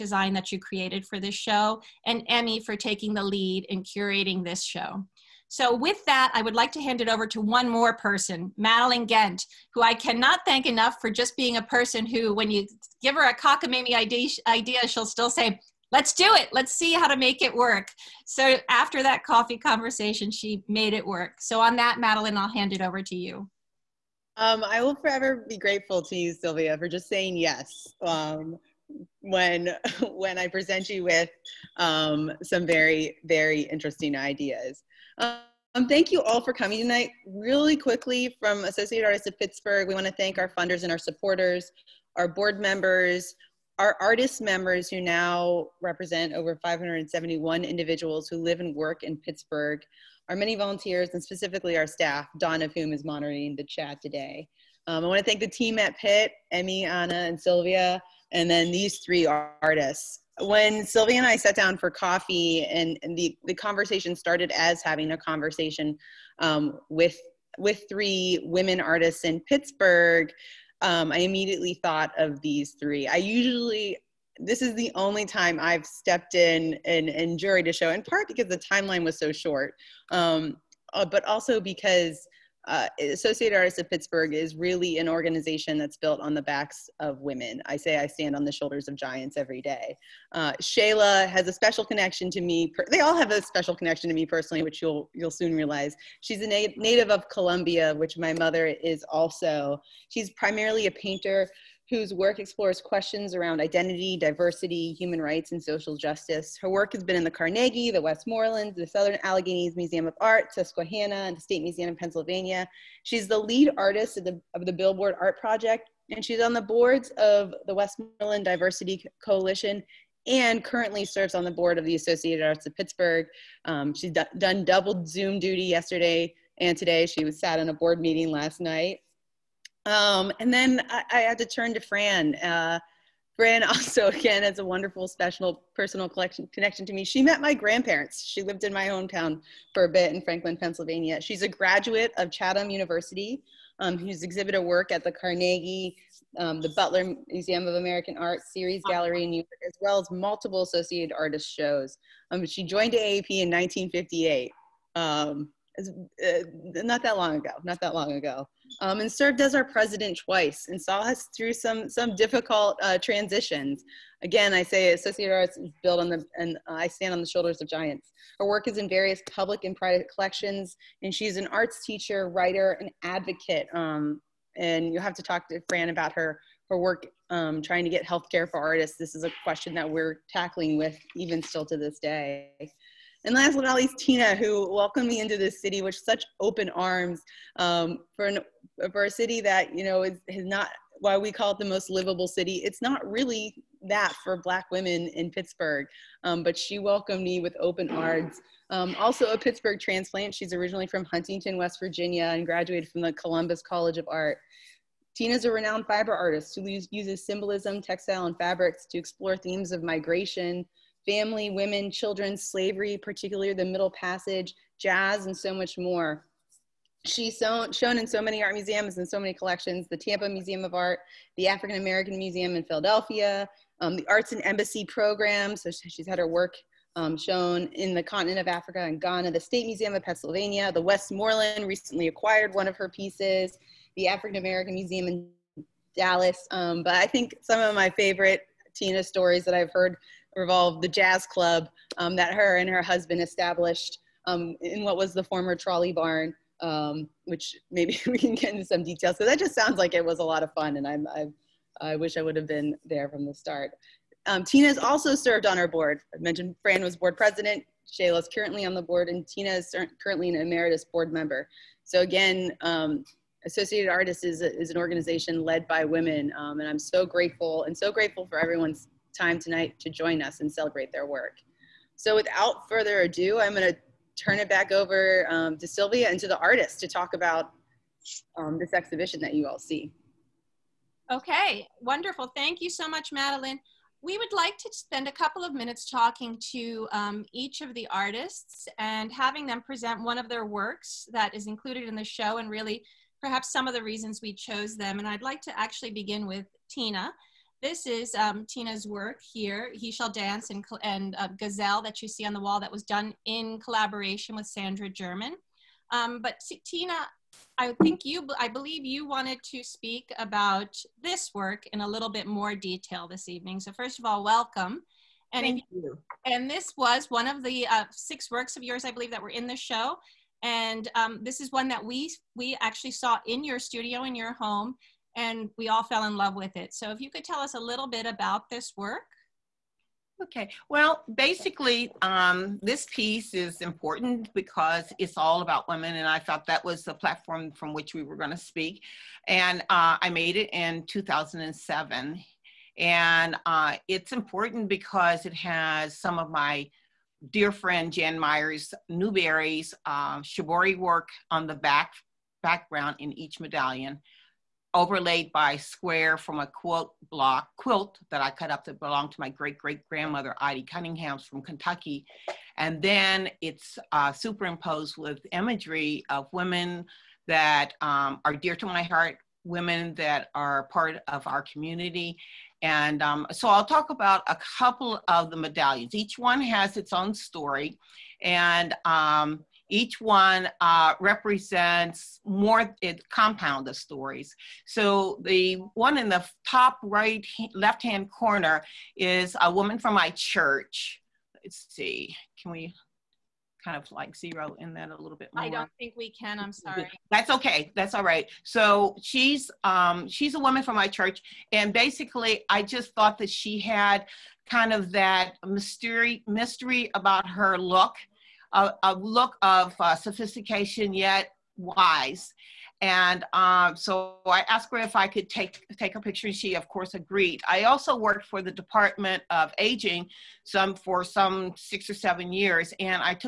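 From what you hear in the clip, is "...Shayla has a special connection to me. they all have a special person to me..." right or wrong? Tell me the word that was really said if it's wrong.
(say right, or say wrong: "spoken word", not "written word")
wrong: "connection", not "person".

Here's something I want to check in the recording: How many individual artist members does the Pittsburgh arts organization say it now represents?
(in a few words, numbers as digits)
571.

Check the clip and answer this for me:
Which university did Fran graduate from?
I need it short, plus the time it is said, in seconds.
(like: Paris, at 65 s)
Chatham University, at 142 s.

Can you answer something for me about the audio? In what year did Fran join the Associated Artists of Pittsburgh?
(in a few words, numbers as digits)
1958.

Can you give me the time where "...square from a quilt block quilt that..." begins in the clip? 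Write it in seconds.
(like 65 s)
355 s.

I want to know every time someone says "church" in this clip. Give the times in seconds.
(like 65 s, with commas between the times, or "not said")
390 s, 400 s.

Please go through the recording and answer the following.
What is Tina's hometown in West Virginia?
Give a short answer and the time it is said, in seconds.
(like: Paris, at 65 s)
Huntington, at 201 s.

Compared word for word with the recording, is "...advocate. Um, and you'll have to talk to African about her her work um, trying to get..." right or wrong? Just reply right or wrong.
wrong.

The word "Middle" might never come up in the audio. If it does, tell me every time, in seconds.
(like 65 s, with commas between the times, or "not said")
213 s.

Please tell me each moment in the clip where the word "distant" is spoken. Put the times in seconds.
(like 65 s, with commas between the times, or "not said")
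not said.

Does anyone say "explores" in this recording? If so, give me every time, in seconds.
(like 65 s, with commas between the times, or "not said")
102 s, 208 s.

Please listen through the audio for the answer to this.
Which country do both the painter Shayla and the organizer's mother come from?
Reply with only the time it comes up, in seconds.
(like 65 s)
97 s.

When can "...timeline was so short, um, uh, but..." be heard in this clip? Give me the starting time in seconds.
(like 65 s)
78 s.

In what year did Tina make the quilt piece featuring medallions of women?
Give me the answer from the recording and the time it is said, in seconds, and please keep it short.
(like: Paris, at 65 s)
2007, at 340 s.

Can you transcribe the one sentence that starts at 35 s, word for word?
Um, thank you all for coming tonight.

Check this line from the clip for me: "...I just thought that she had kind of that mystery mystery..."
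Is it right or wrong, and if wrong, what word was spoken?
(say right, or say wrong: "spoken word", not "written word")
right.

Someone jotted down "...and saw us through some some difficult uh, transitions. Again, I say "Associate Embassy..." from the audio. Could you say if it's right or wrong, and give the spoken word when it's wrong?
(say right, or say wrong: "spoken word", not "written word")
wrong: "Arts", not "Embassy".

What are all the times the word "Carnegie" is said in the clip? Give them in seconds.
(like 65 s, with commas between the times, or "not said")
107 s, 145 s.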